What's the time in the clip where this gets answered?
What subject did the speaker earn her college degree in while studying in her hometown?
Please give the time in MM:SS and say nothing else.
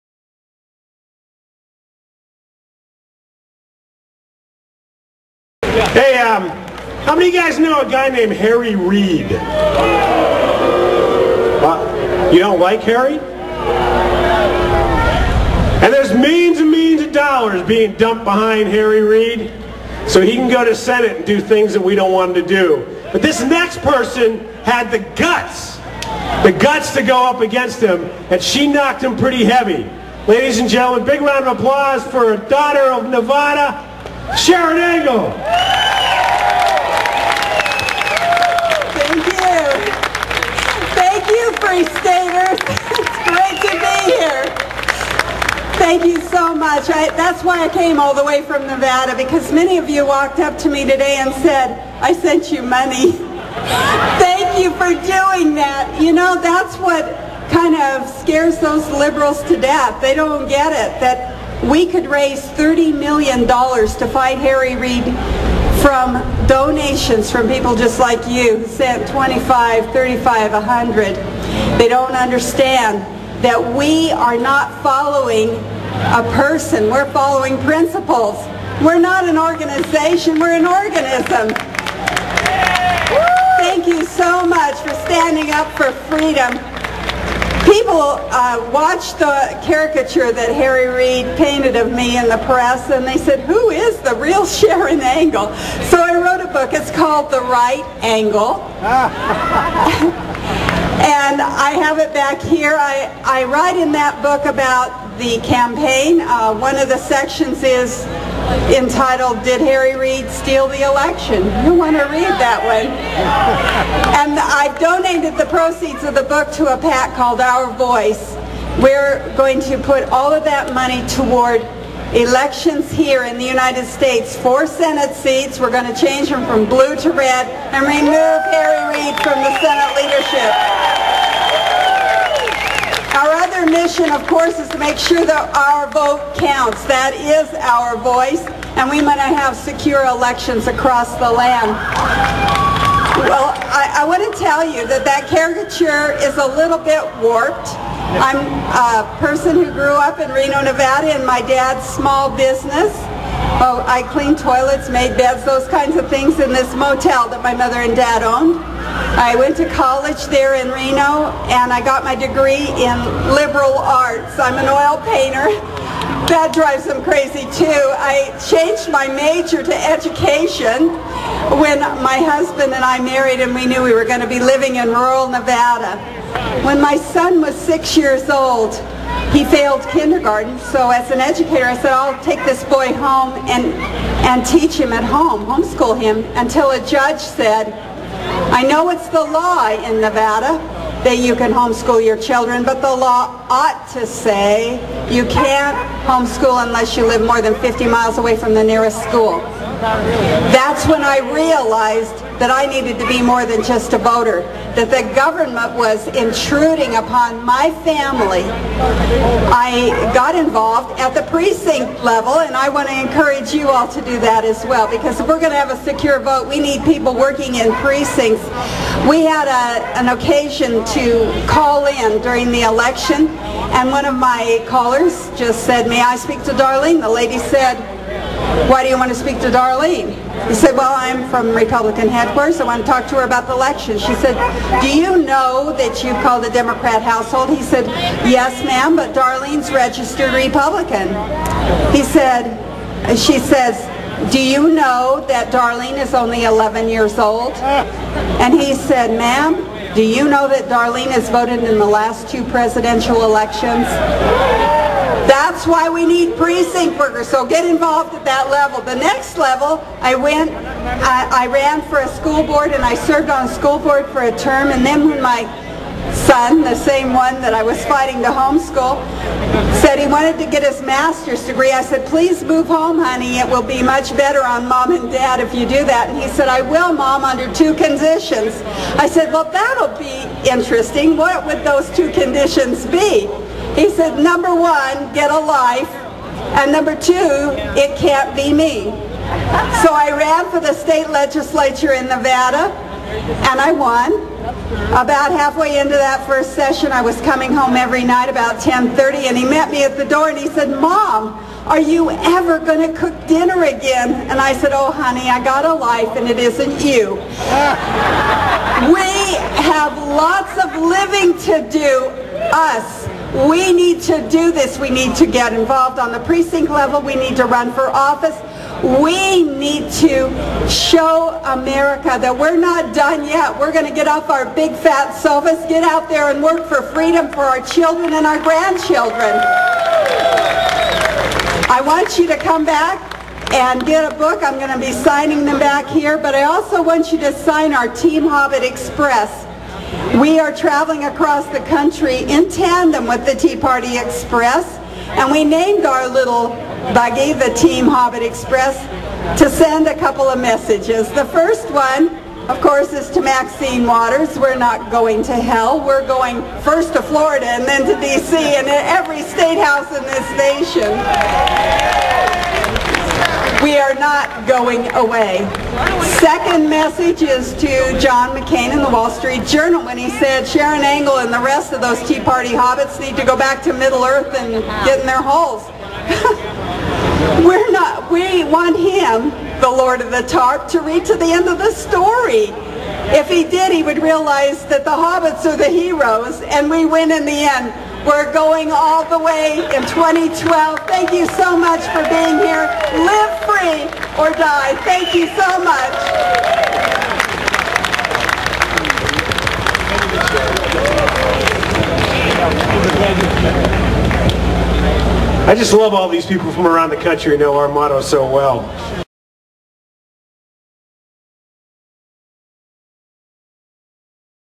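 02:43.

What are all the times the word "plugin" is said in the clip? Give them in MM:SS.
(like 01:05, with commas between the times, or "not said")
not said.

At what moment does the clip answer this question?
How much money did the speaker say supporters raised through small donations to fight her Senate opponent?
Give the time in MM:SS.
01:02.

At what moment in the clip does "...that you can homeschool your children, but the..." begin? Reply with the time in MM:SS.
03:11.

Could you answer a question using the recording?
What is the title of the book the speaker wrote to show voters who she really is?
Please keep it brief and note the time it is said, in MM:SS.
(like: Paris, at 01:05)
The Right Angle, at 01:37.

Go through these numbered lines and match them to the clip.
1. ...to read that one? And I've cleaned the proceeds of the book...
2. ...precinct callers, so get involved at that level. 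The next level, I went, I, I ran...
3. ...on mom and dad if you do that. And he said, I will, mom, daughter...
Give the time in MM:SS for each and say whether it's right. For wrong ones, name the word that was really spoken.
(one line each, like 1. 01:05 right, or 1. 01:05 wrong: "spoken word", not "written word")
1. 01:51 wrong: "donated", not "cleaned"
2. 04:16 wrong: "workers", not "callers"
3. 04:34 wrong: "under", not "daughter".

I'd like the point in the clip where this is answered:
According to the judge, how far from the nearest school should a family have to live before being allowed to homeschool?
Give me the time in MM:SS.
03:17.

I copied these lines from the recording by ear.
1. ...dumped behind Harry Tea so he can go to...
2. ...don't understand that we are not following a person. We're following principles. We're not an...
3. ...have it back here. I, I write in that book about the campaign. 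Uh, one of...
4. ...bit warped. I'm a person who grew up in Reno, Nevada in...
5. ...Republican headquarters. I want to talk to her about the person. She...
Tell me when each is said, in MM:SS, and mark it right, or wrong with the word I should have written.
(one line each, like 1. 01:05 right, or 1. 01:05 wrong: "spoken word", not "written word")
1. 00:17 wrong: "Reid", not "Tea"
2. 01:11 right
3. 01:41 right
4. 02:26 right
5. 03:51 wrong: "election", not "person".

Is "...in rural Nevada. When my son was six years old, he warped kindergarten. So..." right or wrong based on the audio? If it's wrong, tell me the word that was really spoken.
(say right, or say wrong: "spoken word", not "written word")
wrong: "failed", not "warped".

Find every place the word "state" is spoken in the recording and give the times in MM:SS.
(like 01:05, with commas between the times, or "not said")
02:03, 04:50, 05:59.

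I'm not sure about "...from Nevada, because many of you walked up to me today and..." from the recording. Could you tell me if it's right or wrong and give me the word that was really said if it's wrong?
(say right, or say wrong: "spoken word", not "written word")
right.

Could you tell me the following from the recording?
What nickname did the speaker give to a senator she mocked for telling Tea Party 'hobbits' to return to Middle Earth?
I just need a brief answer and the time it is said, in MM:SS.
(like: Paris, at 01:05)
Lord of the Tarp, at 06:19.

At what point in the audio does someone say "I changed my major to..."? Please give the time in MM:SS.
02:48.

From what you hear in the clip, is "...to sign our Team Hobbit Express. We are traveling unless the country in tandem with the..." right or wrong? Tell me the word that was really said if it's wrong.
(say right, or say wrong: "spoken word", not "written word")
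wrong: "across", not "unless".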